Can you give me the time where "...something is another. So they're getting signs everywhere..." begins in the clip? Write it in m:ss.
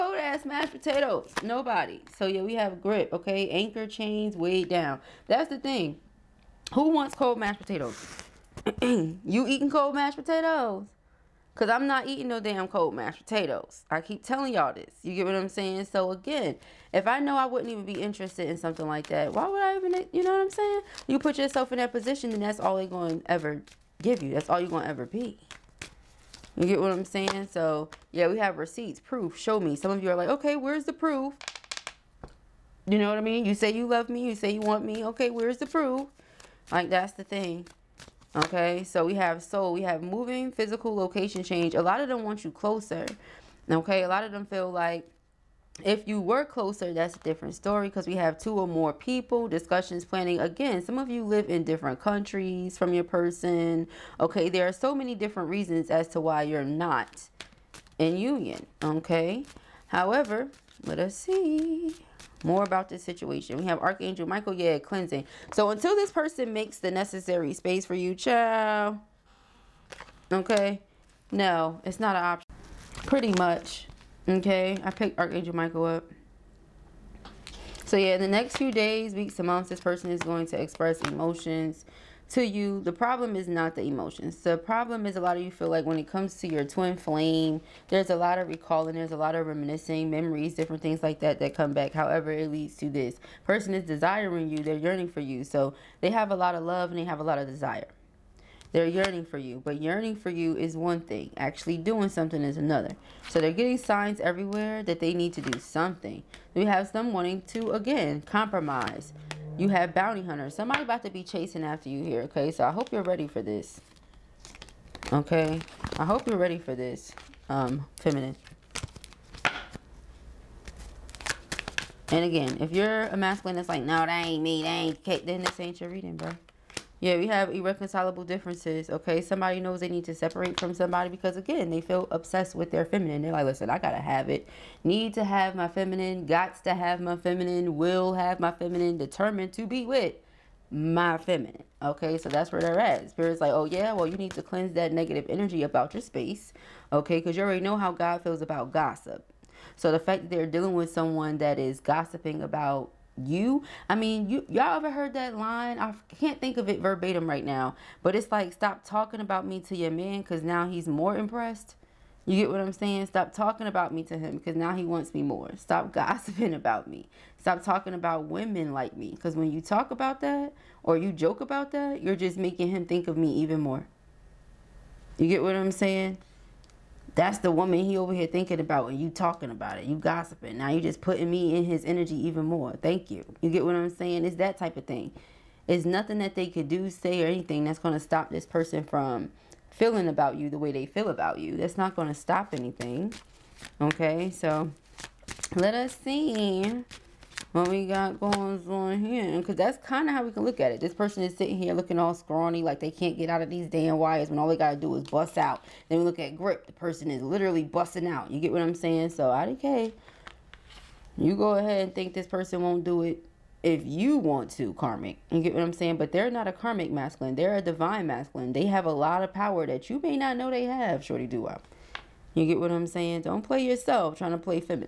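1:42.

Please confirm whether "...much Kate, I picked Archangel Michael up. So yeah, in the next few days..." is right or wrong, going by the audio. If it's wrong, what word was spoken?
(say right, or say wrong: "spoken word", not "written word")
wrong: "Okay", not "Kate".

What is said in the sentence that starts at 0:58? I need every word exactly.
Okay, however, let us see more about this situation.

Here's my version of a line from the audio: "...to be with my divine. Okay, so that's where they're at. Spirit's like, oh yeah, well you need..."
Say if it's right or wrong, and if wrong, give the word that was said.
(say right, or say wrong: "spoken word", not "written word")
wrong: "feminine", not "divine".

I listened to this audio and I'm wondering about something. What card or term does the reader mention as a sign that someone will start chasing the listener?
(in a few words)
Bounty hunters.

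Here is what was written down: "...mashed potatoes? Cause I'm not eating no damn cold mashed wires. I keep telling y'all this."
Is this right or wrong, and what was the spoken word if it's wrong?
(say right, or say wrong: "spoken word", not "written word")
wrong: "potatoes", not "wires".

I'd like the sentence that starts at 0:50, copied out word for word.
Again, some of you live in different countries from your person.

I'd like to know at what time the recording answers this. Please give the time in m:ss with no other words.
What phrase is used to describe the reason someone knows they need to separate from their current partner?
2:07.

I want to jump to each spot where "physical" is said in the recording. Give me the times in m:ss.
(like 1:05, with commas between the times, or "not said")
0:40.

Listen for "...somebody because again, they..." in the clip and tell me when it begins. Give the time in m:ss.
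2:10.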